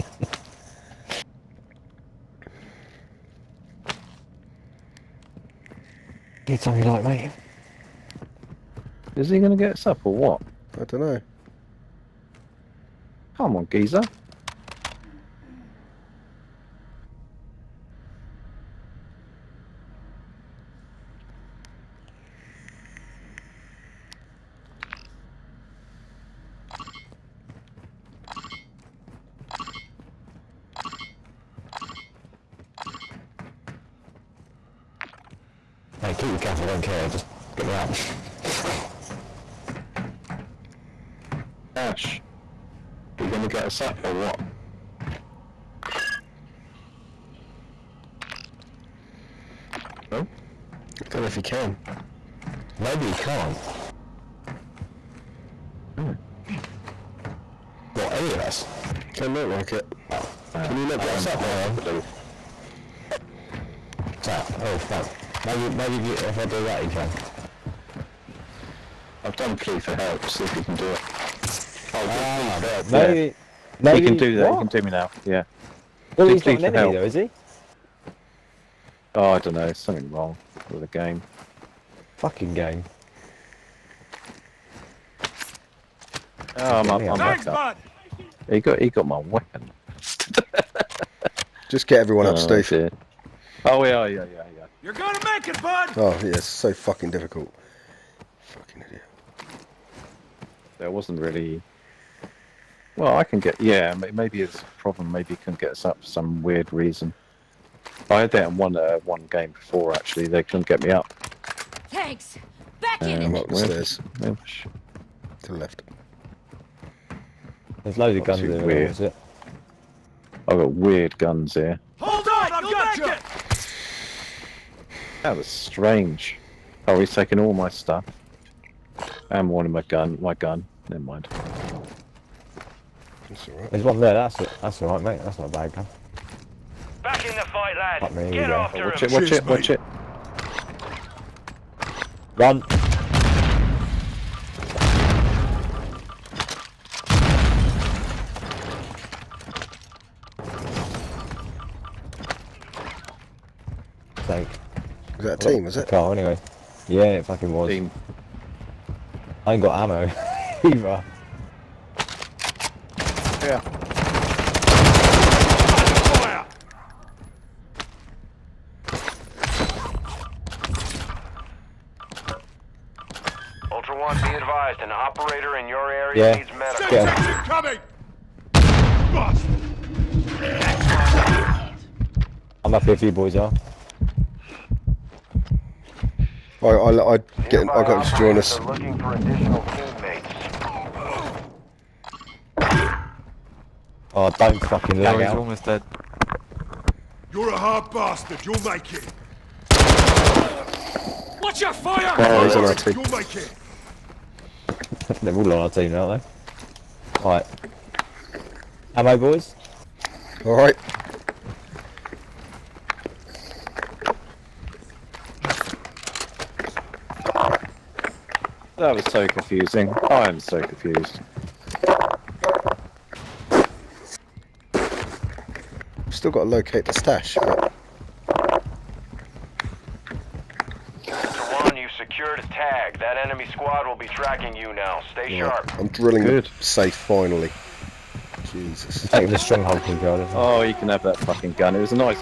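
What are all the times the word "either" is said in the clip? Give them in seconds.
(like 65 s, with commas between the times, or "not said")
160 s.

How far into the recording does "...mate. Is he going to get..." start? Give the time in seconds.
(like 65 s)
7 s.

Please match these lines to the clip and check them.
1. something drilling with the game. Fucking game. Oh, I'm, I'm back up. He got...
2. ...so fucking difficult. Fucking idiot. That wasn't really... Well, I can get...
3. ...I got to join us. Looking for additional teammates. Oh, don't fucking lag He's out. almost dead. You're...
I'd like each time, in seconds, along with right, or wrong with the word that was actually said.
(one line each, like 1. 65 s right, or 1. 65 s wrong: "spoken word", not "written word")
1. 79 s wrong: "wrong", not "drilling"
2. 96 s right
3. 187 s right.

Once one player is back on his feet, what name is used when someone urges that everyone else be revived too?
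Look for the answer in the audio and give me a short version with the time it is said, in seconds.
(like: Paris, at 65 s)
Steve, at 92 s.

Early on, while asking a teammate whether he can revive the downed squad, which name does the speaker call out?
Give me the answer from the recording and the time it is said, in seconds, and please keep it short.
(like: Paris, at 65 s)
Ash, at 41 s.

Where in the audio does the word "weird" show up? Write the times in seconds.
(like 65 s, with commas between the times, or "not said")
106 s, 120 s.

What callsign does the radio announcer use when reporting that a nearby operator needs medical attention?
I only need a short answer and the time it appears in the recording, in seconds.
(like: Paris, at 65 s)
Ultra One, at 173 s.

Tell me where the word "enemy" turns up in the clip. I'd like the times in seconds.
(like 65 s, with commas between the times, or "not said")
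76 s, 233 s.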